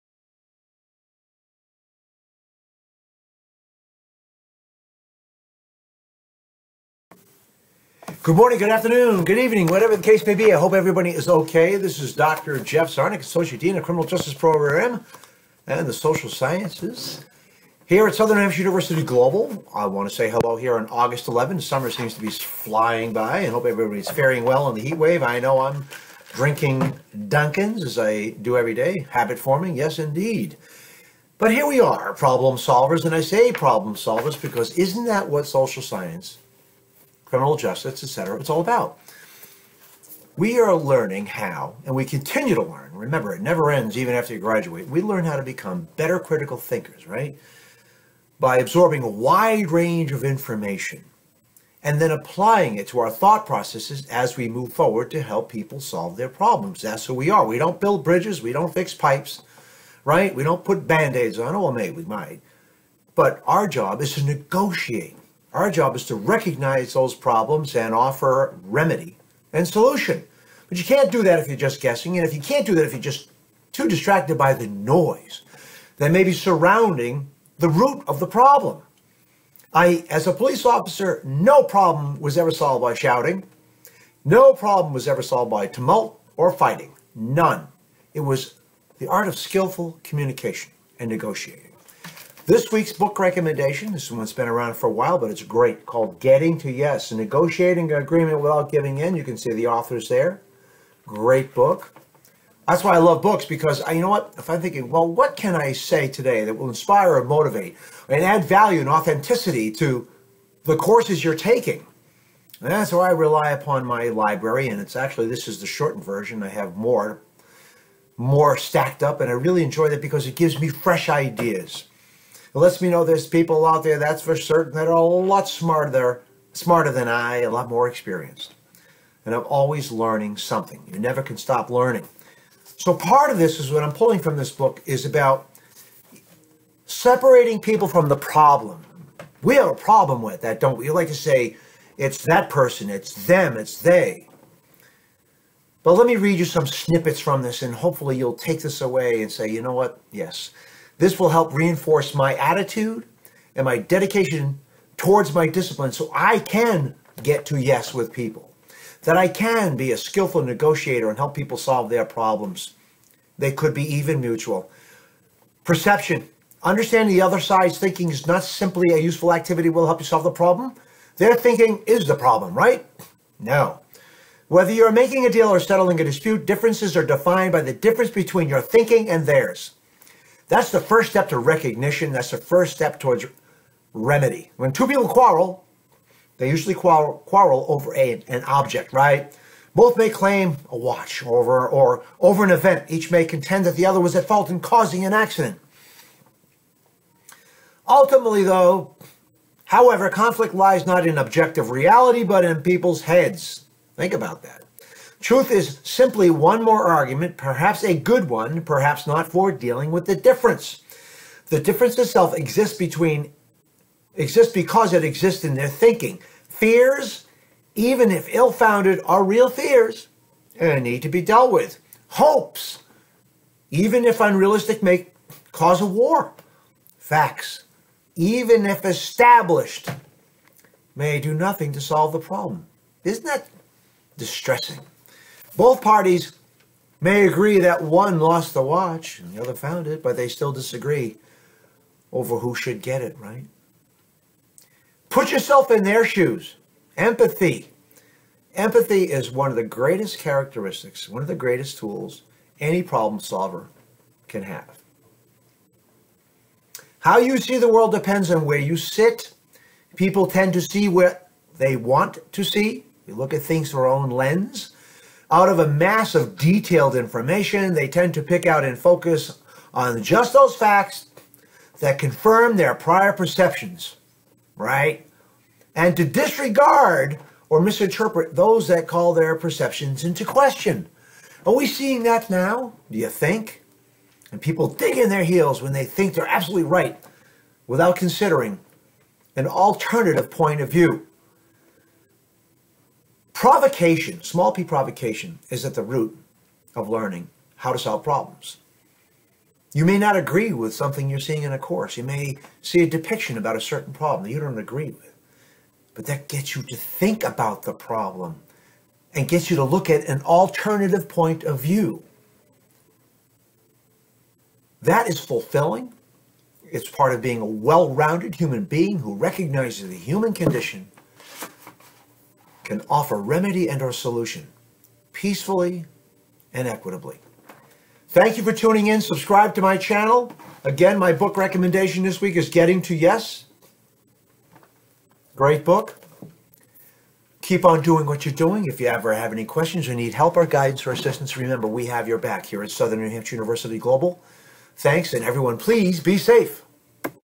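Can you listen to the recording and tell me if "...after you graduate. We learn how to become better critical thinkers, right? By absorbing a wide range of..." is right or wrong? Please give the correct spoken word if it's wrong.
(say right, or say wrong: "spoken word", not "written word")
right.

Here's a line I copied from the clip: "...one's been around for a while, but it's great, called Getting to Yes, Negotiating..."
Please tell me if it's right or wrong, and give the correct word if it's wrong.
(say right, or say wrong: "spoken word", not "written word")
right.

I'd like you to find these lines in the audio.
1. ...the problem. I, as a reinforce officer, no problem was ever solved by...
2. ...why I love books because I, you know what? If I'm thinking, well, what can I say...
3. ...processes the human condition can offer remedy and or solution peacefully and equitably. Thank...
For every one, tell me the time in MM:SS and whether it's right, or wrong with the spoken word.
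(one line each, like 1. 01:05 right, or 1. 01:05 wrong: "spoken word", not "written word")
1. 01:18 wrong: "police", not "reinforce"
2. 01:42 right
3. 05:19 wrong: "recognizes", not "processes".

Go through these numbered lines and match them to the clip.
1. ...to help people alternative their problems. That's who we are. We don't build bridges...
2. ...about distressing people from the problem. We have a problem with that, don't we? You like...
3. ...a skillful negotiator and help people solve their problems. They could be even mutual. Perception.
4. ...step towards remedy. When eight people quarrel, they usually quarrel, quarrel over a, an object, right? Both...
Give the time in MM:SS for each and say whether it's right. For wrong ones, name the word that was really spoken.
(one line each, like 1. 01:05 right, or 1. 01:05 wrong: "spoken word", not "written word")
1. 00:55 wrong: "solve", not "alternative"
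2. 02:15 wrong: "separating", not "distressing"
3. 02:39 right
4. 03:02 wrong: "two", not "eight".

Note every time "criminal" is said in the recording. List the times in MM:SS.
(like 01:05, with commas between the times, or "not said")
00:13, 00:37.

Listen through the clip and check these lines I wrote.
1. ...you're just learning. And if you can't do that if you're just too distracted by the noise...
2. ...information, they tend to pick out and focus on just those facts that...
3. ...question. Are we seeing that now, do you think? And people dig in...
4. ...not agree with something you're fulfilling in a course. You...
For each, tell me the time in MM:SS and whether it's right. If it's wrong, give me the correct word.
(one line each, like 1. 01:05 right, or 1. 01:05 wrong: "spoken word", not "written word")
1. 01:11 wrong: "guessing", not "learning"
2. 04:26 right
3. 04:40 right
4. 04:59 wrong: "seeing", not "fulfilling".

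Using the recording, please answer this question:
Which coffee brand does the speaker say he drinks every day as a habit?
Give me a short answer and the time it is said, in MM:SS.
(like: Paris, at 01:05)
Dunkin's, at 00:27.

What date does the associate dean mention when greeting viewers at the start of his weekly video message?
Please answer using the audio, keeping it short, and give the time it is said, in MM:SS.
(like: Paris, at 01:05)
August 11, at 00:20.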